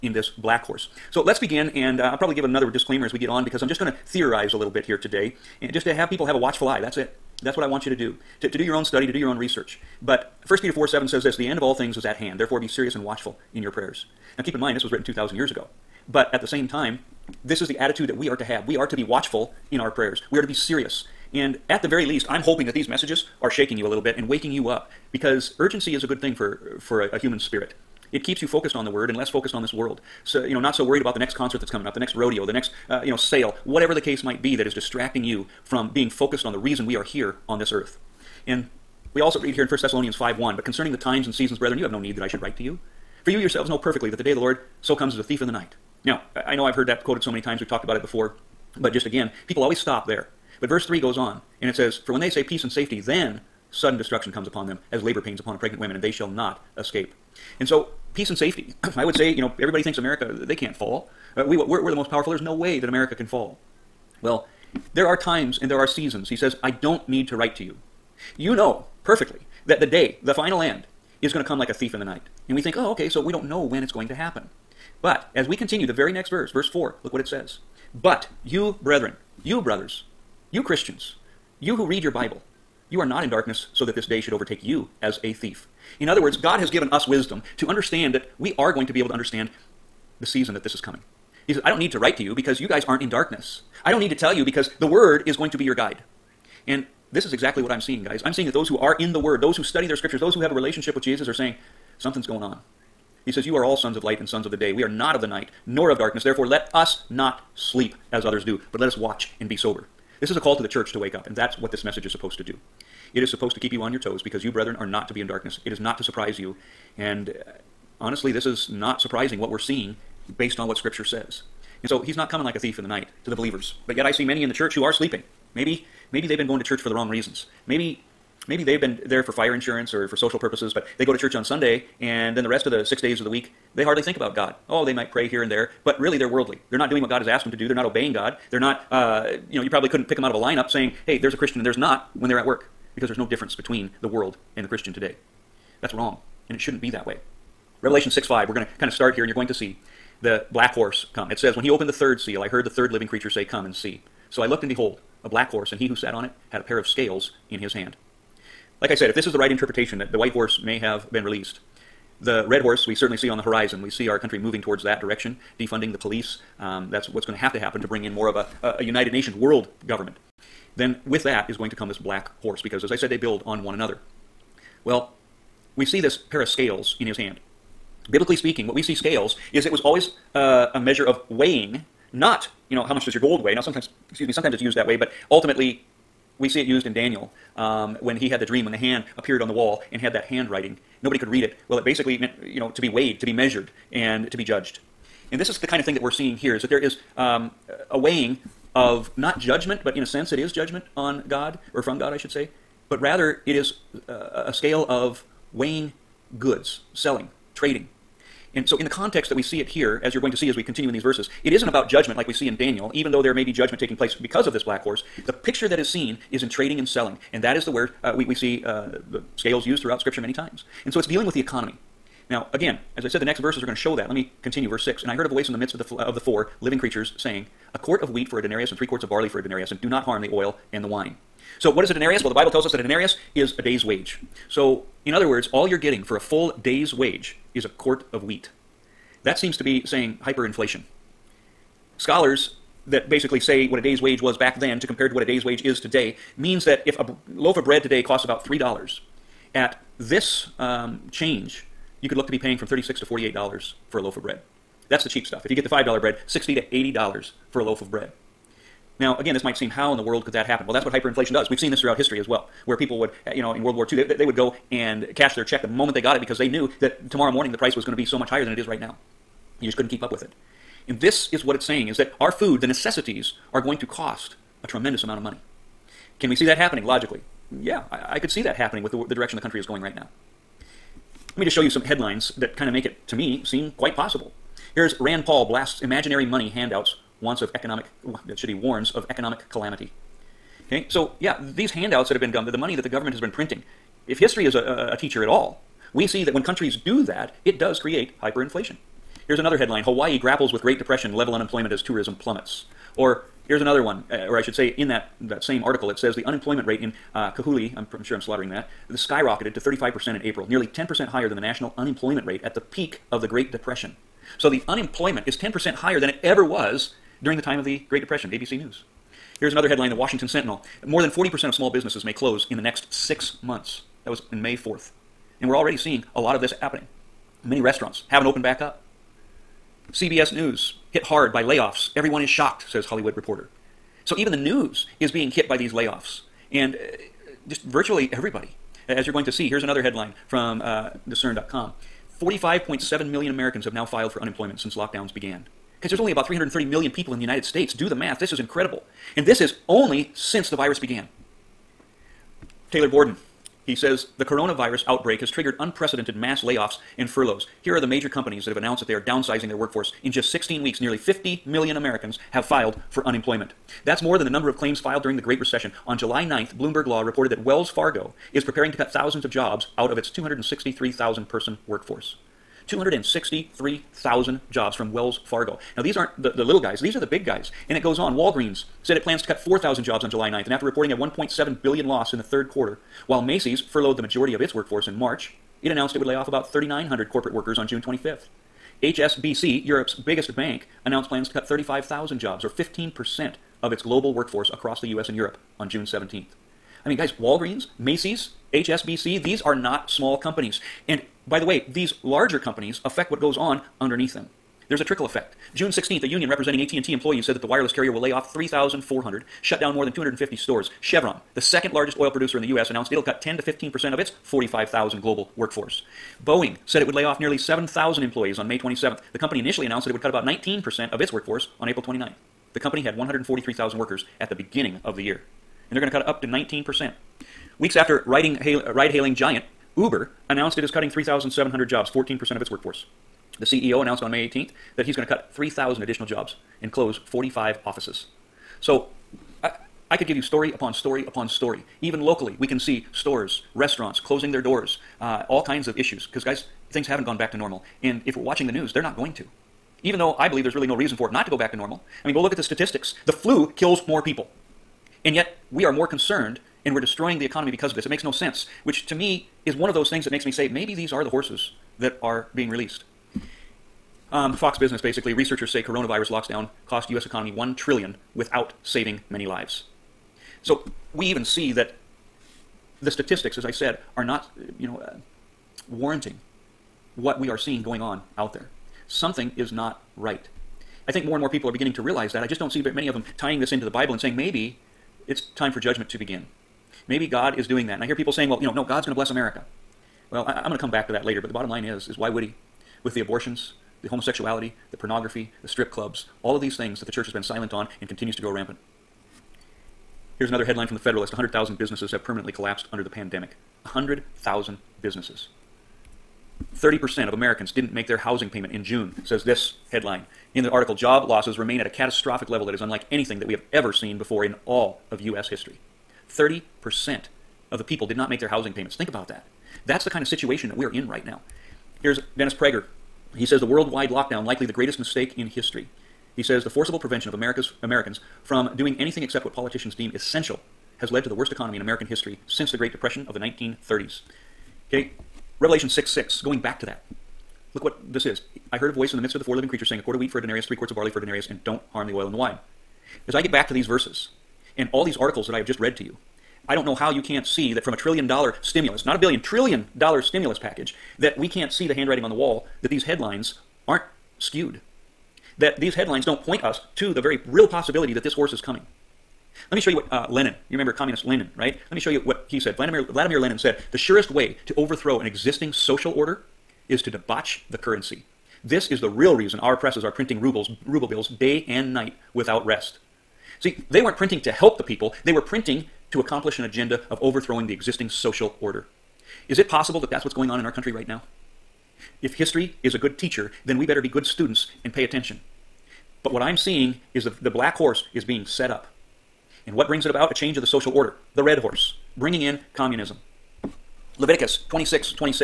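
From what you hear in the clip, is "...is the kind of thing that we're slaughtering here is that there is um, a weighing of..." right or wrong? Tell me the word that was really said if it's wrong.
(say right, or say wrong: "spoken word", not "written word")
wrong: "seeing", not "slaughtering".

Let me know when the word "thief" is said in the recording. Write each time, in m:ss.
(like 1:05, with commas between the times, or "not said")
0:45, 1:11, 1:25, 2:02.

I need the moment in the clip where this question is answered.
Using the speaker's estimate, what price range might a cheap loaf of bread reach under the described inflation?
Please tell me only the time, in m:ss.
4:12.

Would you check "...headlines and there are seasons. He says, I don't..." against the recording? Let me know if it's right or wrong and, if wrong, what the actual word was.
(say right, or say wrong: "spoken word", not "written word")
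wrong: "times", not "headlines".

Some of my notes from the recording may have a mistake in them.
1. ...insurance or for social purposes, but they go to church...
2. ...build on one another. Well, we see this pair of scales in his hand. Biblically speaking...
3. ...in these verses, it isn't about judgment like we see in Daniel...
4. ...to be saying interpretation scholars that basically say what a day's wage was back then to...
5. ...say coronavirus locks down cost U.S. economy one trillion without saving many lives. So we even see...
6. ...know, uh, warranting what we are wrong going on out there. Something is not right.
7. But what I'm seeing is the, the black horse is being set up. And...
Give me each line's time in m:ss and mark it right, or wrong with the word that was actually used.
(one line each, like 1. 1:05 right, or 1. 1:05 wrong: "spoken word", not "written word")
1. 2:09 right
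2. 2:53 right
3. 3:30 right
4. 3:59 wrong: "hyperinflation", not "interpretation"
5. 7:45 right
6. 7:54 wrong: "seeing", not "wrong"
7. 9:46 right.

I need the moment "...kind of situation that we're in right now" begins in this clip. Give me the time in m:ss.
8:39.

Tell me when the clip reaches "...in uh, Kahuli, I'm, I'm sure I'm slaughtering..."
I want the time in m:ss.
5:06.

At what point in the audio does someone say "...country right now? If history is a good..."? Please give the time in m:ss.
9:40.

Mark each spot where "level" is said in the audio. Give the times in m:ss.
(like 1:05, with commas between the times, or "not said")
5:01, 8:32.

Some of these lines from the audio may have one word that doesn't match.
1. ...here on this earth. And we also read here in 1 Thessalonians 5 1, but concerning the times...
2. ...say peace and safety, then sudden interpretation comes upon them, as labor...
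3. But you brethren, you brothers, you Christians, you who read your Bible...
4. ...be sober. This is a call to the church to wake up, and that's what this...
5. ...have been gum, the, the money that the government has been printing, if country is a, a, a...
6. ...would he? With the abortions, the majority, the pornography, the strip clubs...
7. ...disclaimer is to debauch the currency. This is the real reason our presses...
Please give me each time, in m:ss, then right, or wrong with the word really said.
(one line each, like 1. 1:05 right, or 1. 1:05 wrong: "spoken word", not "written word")
1. 0:37 right
2. 0:52 wrong: "destruction", not "interpretation"
3. 1:17 right
4. 1:49 right
5. 4:52 wrong: "history", not "country"
6. 8:12 wrong: "homosexuality", not "majority"
7. 9:25 wrong: "order", not "disclaimer".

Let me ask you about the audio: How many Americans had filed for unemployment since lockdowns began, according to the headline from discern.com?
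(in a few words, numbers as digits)
45.7 million.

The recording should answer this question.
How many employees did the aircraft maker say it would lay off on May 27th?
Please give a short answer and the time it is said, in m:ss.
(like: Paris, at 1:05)
nearly 7,000, at 6:57.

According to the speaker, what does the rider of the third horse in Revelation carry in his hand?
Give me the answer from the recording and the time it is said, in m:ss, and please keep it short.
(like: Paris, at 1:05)
A pair of scales, at 2:36.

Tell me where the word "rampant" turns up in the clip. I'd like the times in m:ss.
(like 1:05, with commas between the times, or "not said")
8:18.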